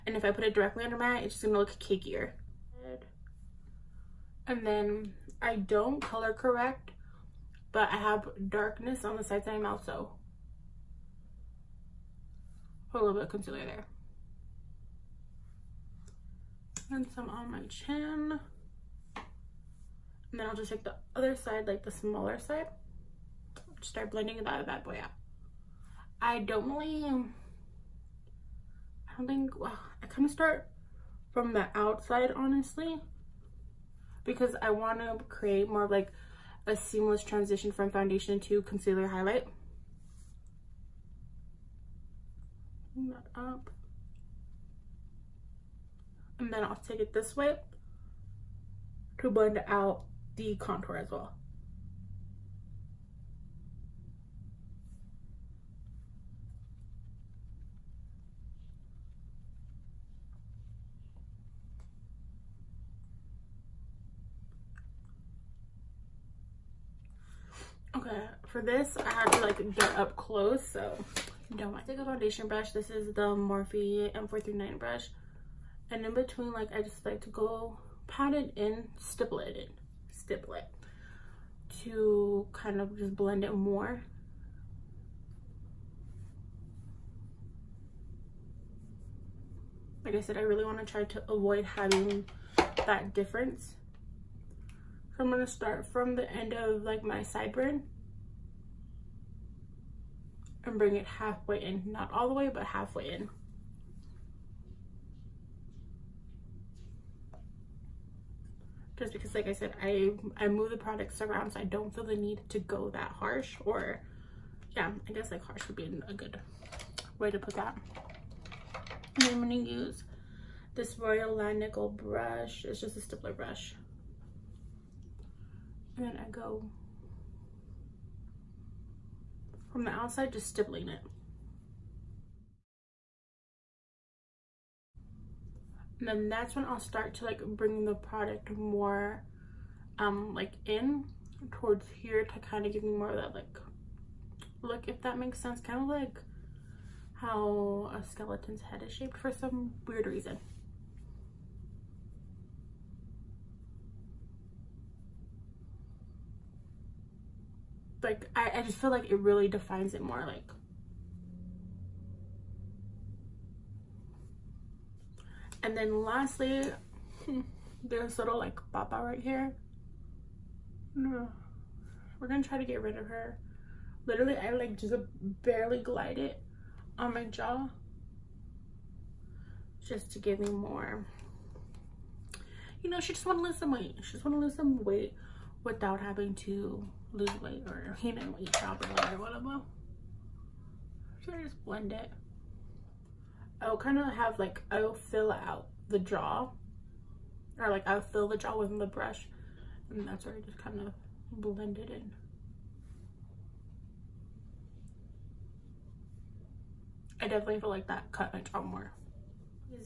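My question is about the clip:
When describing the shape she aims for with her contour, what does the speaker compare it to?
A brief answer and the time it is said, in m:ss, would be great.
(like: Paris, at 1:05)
a skeleton's head, at 2:28.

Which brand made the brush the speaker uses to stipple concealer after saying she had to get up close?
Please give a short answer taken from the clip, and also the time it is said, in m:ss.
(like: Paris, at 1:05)
Morphe, at 1:13.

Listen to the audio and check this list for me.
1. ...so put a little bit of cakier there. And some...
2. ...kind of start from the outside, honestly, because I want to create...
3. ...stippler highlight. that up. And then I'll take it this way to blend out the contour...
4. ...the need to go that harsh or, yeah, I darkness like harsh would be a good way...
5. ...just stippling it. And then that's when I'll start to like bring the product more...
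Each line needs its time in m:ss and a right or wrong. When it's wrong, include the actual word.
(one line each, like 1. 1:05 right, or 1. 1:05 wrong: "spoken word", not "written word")
1. 0:09 wrong: "concealer", not "cakier"
2. 0:30 right
3. 0:38 wrong: "concealer", not "stippler"
4. 1:52 wrong: "guess", not "darkness"
5. 2:10 right.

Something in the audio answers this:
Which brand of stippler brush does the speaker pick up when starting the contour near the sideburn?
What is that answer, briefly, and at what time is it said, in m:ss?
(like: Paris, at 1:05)
Royal Langnickel, at 2:00.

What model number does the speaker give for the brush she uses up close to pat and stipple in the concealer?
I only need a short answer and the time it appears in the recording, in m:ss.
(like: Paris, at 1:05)
M439, at 1:14.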